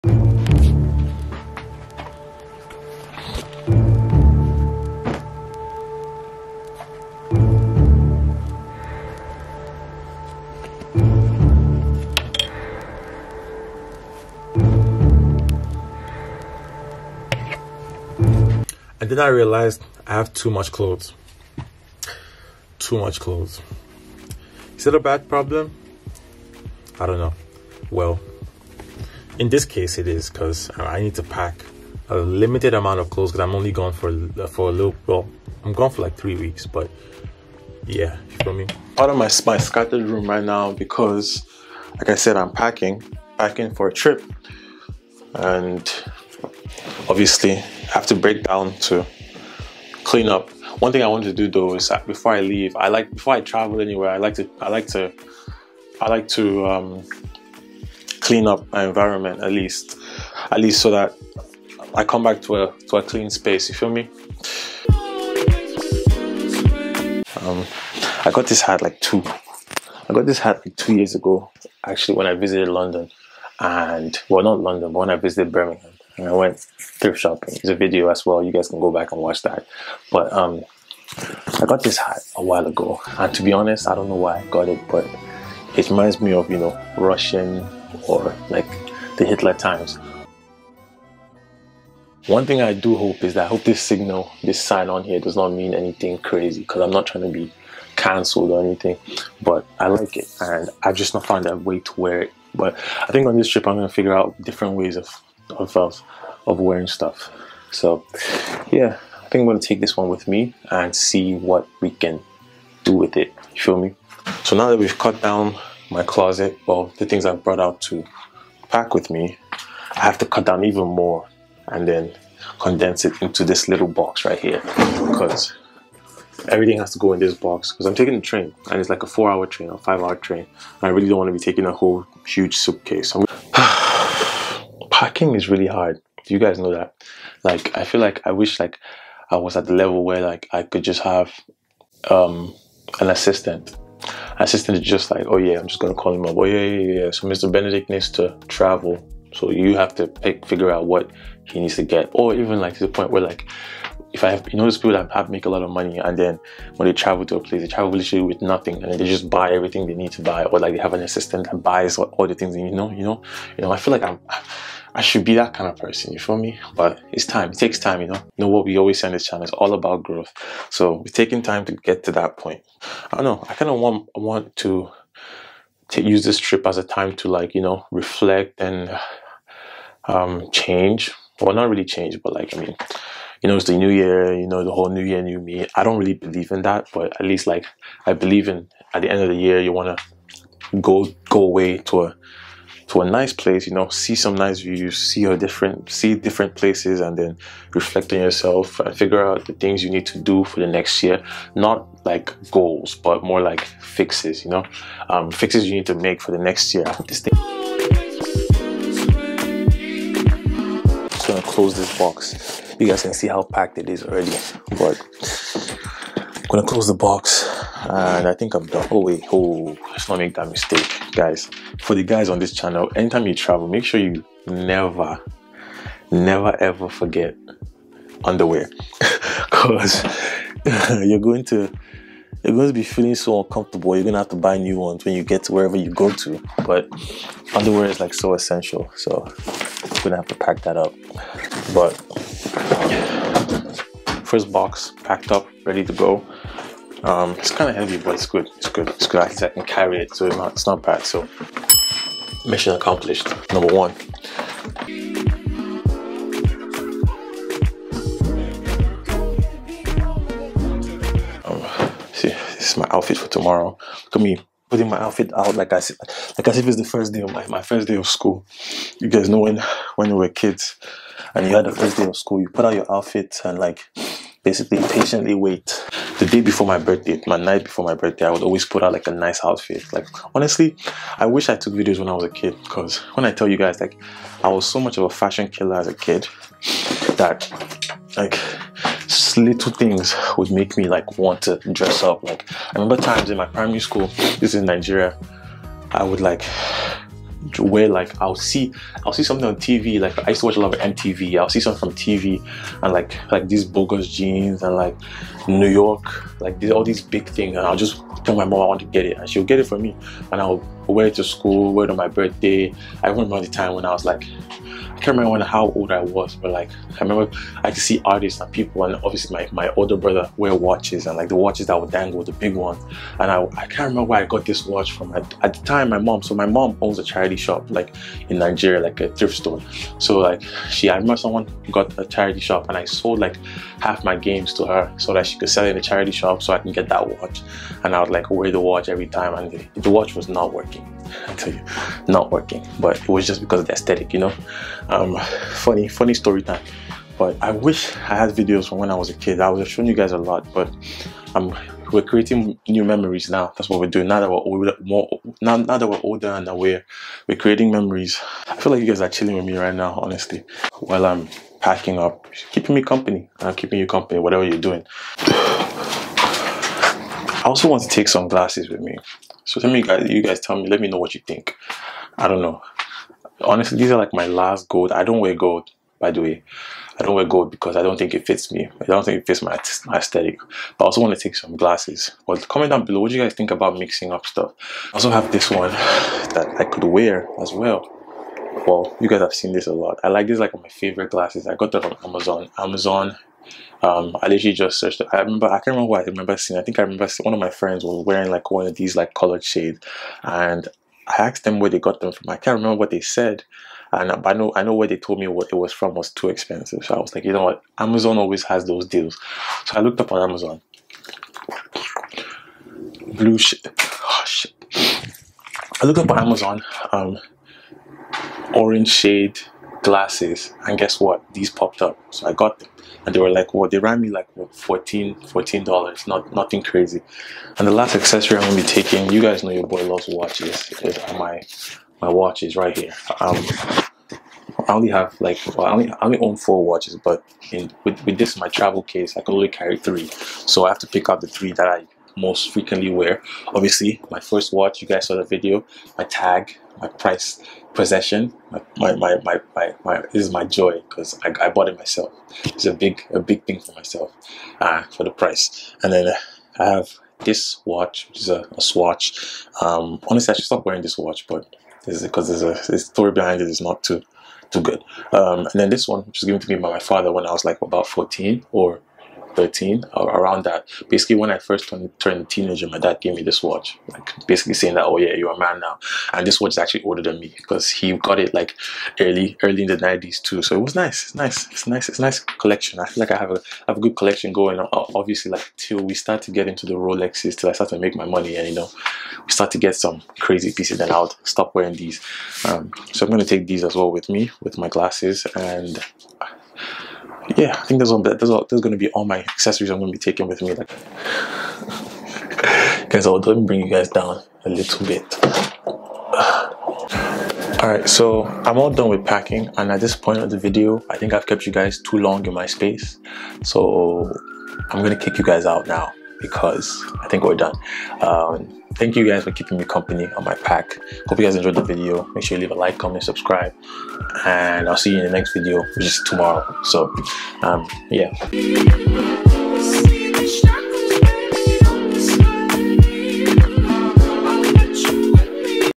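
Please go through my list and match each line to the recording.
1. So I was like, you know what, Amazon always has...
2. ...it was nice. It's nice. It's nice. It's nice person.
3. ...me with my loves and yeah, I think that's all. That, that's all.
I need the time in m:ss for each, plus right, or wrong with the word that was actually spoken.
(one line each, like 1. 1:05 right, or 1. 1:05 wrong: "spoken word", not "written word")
1. 6:46 right
2. 8:00 wrong: "collection", not "person"
3. 8:14 wrong: "glasses", not "loves".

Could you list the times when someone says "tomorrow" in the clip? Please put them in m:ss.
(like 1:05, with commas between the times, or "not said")
4:23, 8:46.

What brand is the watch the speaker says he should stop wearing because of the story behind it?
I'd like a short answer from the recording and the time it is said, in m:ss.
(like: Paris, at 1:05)
Swatch, at 7:38.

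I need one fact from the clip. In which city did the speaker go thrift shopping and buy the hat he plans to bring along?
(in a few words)
Birmingham.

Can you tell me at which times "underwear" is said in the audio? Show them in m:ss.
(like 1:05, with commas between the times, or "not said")
3:48, 3:57.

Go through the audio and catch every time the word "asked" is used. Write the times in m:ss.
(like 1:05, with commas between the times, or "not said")
6:41.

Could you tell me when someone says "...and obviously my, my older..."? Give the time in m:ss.
5:18.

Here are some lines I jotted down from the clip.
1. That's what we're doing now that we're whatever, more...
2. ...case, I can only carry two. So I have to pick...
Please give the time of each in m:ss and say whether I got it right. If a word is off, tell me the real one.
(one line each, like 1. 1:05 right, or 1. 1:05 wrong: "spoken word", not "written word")
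1. 5:53 wrong: "older", not "whatever"
2. 7:18 wrong: "three", not "two".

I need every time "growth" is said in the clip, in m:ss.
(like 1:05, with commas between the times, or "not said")
2:50.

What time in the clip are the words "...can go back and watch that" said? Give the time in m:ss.
1:18.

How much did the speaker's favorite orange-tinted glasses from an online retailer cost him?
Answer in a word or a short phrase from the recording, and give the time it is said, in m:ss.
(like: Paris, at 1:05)
$14, at 7:04.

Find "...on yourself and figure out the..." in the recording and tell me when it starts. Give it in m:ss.
3:18.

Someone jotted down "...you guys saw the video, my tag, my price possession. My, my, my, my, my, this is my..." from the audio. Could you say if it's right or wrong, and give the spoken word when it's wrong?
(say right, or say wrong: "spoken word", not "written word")
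right.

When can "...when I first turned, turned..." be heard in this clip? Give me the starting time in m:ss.
7:51.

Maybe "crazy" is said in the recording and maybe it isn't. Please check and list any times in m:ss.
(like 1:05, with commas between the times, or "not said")
1:36, 7:06, 8:10.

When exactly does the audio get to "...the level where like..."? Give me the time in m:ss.
2:19.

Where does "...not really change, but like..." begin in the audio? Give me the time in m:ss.
3:01.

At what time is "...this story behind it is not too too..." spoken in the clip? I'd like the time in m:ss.
7:42.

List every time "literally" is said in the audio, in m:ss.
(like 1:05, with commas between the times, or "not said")
2:37, 6:34.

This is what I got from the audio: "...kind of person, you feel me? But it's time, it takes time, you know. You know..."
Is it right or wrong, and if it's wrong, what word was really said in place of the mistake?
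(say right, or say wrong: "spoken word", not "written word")
right.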